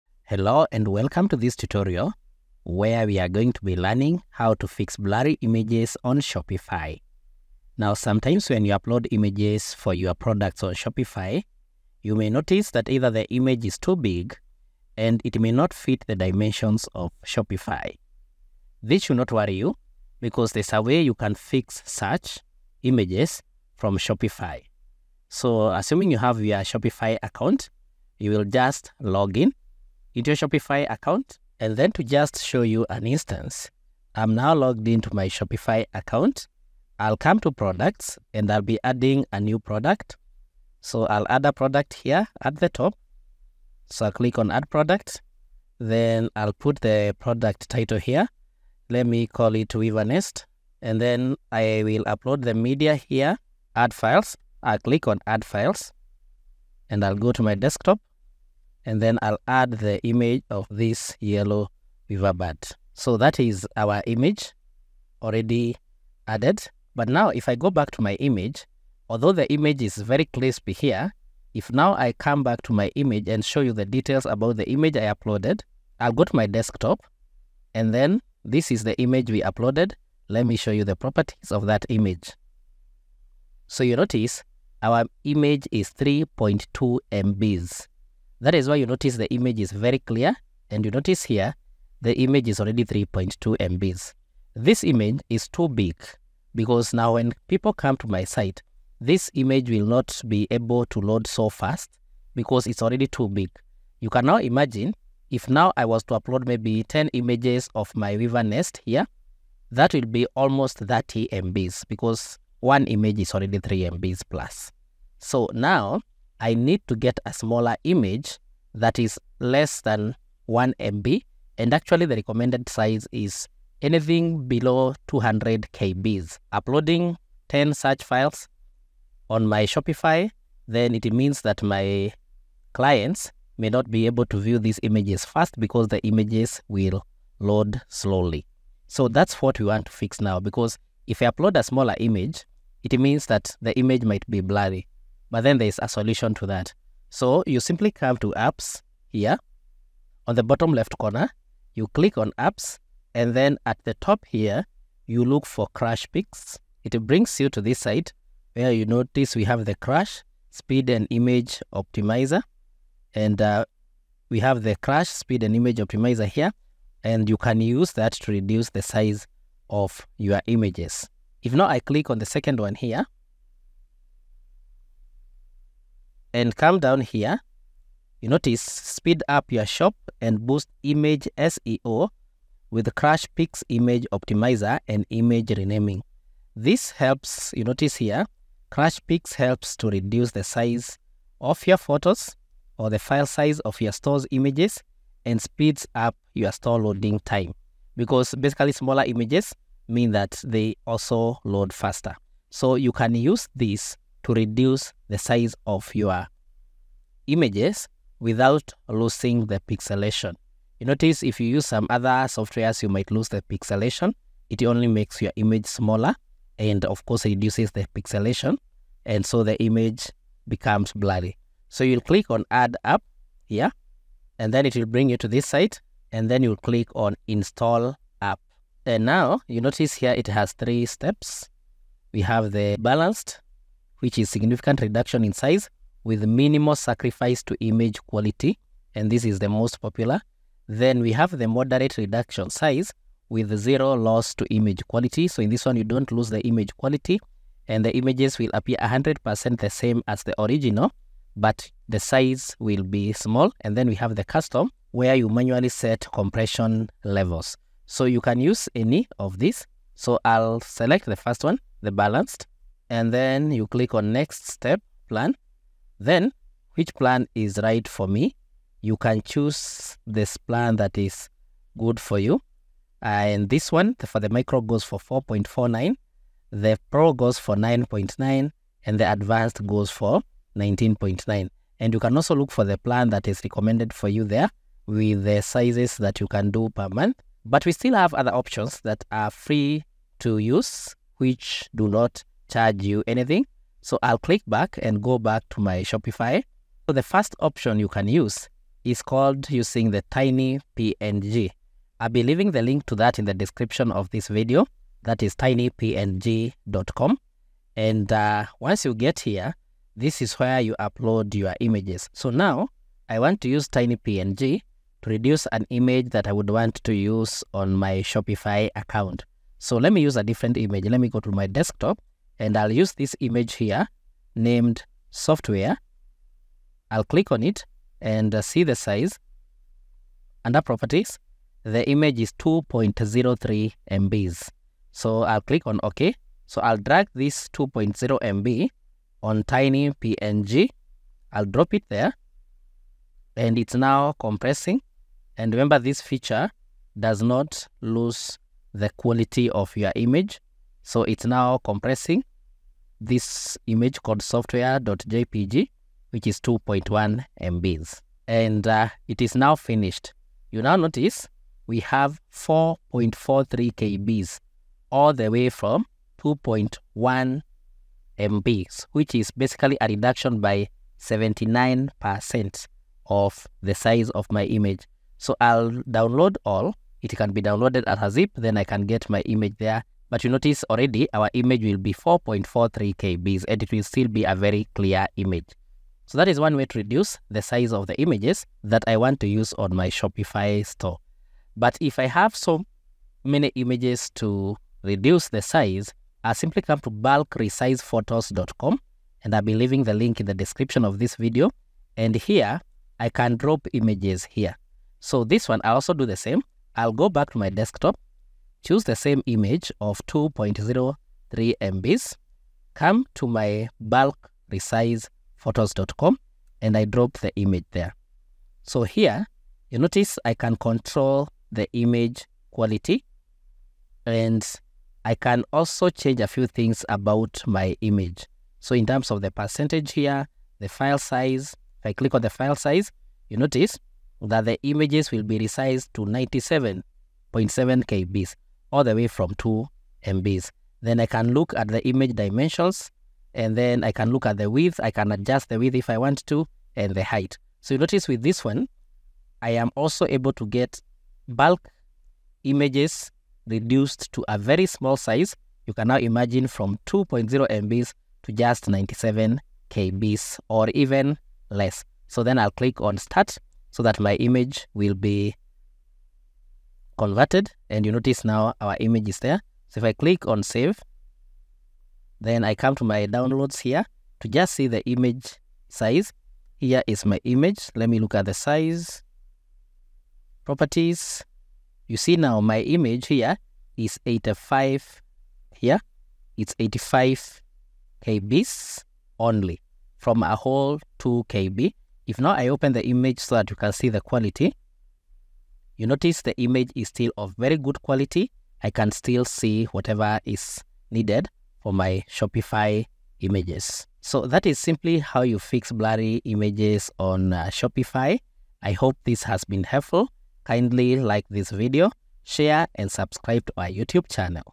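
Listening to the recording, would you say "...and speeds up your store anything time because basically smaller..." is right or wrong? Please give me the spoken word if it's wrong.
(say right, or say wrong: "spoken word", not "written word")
wrong: "loading", not "anything".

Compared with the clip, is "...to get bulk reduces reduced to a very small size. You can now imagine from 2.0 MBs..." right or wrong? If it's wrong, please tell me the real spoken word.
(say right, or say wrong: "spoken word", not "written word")
wrong: "images", not "reduces".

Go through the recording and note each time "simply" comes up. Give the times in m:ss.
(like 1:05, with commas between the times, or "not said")
2:27, 6:36, 8:24.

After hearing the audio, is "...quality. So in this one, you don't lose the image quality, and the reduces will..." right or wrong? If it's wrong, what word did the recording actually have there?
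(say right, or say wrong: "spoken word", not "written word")
wrong: "images", not "reduces".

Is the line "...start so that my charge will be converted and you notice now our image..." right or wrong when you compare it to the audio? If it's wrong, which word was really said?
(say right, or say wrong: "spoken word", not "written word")
wrong: "image", not "charge".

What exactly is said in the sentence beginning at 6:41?
And here, I can drop images here.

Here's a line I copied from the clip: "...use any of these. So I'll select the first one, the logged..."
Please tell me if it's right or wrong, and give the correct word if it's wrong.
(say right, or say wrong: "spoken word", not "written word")
wrong: "balanced", not "logged".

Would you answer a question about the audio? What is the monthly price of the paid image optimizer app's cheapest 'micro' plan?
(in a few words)
4.49.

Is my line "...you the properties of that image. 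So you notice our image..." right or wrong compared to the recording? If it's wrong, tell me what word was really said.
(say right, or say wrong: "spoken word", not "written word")
right.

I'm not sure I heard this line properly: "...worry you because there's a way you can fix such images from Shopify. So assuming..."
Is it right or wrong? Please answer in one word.
right.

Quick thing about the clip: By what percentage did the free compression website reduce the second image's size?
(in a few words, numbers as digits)
79%.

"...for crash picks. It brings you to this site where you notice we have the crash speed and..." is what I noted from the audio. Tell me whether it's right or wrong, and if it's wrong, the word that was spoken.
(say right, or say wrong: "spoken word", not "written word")
right.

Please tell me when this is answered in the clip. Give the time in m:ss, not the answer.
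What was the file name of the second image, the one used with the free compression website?
5:54.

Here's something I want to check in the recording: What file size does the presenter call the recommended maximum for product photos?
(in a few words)
200 KB.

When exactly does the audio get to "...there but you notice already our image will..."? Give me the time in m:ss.
6:19.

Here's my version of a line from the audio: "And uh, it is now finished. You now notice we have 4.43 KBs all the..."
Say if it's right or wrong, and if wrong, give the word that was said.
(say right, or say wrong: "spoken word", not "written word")
right.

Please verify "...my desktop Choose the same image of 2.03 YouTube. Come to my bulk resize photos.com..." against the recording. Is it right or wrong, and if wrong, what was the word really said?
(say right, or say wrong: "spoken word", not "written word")
wrong: "MBs", not "YouTube".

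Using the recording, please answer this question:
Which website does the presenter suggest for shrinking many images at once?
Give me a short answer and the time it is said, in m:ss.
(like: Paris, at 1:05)
bulkresizephotos.com, at 6:36.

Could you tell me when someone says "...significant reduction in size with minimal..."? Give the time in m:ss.
3:54.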